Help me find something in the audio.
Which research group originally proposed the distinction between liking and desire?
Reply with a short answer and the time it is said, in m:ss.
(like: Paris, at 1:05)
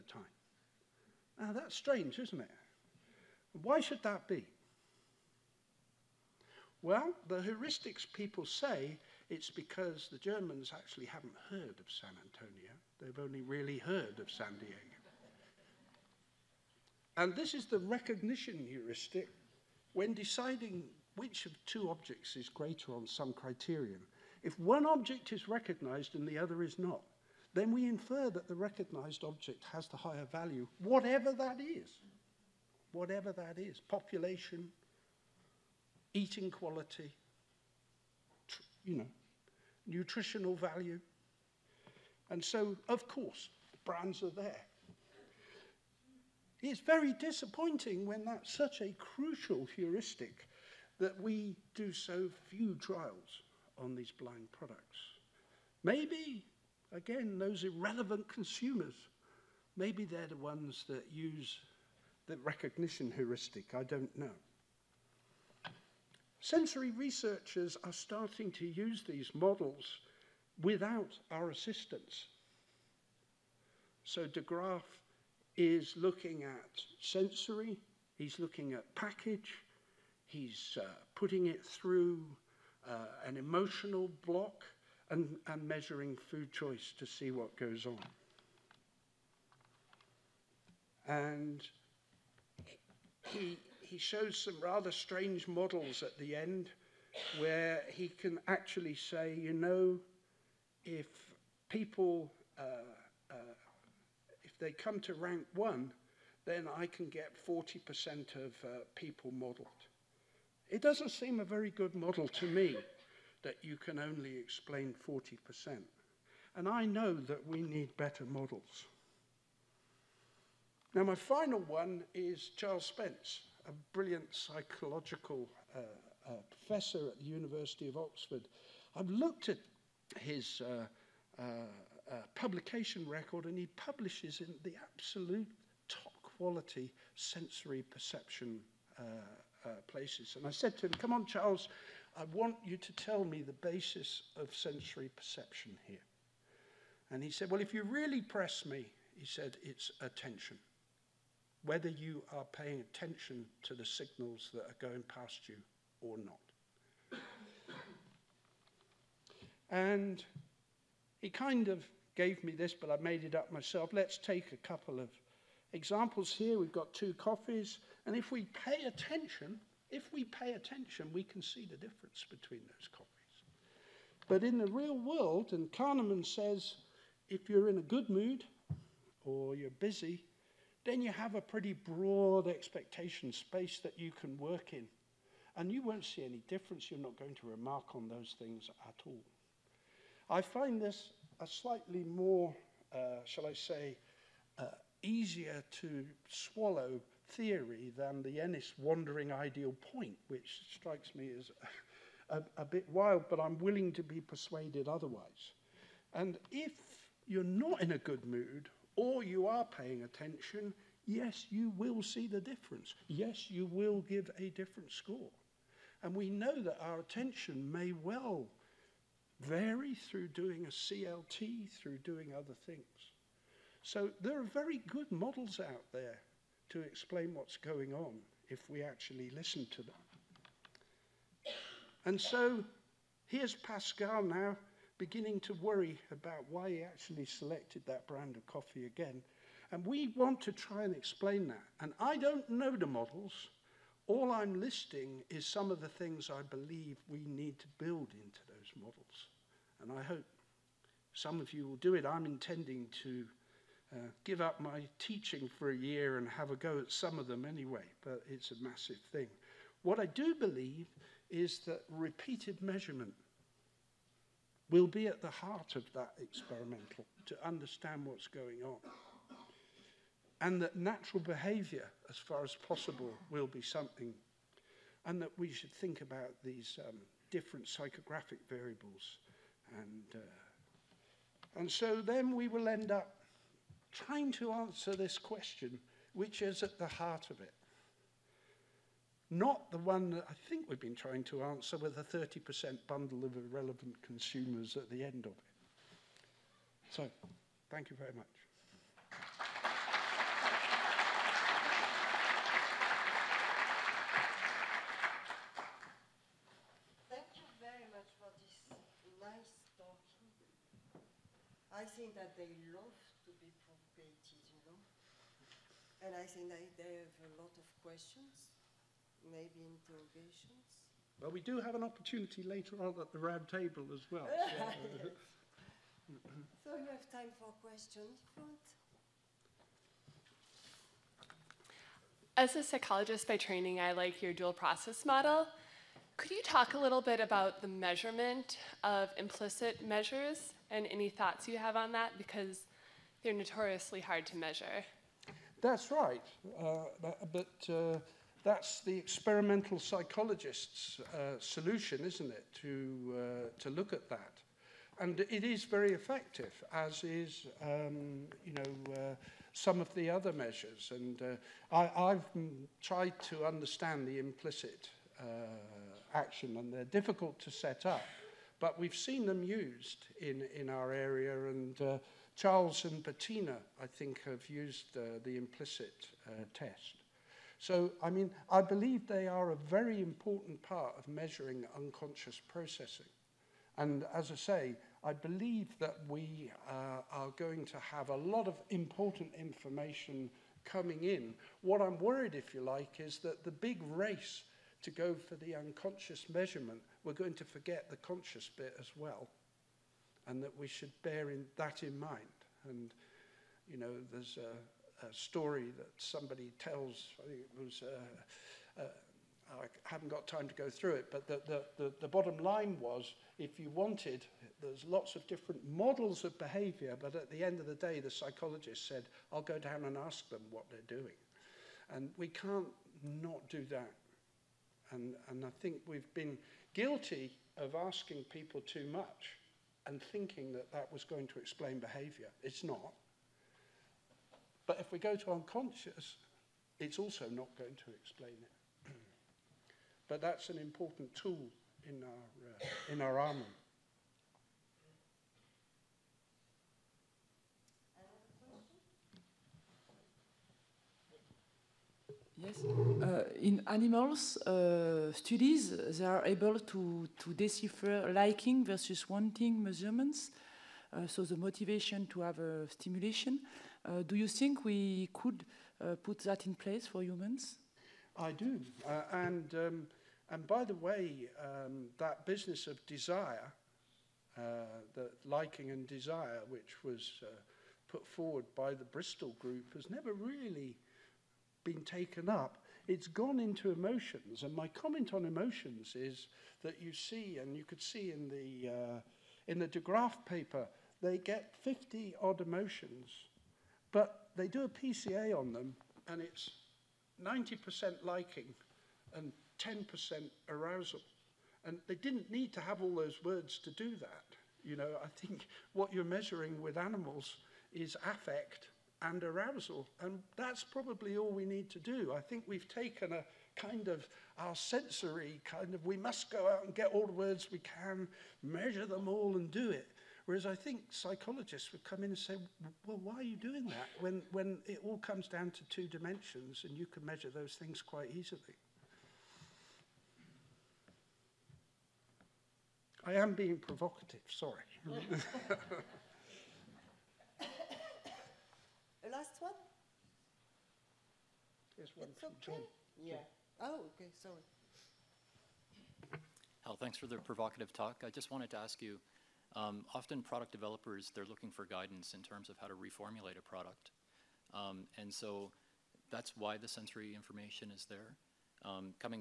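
the Bristol group, at 7:58.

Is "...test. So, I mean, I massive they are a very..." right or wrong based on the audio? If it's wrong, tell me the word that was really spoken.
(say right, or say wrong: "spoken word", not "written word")
wrong: "believe", not "massive".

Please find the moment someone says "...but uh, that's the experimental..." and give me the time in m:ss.
5:47.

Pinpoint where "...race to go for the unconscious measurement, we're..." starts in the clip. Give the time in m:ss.
6:33.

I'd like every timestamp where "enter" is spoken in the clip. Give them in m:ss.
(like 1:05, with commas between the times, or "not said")
not said.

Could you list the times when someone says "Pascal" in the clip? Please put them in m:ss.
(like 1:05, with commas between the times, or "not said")
3:53.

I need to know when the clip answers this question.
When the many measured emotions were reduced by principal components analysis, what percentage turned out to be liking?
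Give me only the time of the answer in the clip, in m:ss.
8:17.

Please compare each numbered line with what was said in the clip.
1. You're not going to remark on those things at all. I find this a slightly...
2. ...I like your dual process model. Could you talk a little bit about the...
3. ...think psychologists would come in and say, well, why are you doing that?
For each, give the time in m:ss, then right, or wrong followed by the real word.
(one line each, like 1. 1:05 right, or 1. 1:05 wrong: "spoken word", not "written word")
1. 3:06 right
2. 5:33 right
3. 8:40 right.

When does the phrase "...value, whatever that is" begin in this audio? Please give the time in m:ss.
0:30.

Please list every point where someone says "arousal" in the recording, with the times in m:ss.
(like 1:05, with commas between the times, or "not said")
8:20, 8:29.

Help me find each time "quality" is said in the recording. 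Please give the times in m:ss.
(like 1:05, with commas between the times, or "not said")
0:36, 2:16.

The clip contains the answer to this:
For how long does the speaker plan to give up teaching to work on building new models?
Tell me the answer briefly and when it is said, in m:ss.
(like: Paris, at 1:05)
a year, at 4:15.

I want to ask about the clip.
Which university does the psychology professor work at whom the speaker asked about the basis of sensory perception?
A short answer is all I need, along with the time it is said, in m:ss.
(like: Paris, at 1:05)
University of Oxford, at 2:07.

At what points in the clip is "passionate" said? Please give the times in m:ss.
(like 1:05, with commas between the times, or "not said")
not said.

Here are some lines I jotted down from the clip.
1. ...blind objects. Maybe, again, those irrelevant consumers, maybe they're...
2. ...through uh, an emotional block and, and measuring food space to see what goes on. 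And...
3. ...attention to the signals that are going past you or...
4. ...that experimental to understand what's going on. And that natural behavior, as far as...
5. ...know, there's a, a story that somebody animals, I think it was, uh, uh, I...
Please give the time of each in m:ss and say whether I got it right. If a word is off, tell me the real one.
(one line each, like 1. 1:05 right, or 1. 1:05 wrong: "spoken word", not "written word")
1. 0:54 wrong: "products", not "objects"
2. 1:21 wrong: "choice", not "space"
3. 2:32 right
4. 4:25 right
5. 6:43 wrong: "tells", not "animals".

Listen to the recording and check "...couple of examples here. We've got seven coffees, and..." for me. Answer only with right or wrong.
wrong.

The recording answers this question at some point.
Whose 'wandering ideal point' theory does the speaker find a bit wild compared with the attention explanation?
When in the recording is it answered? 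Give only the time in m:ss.
3:18.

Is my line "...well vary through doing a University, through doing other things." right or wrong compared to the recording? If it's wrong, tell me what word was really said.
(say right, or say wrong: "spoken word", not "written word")
wrong: "CLT", not "University".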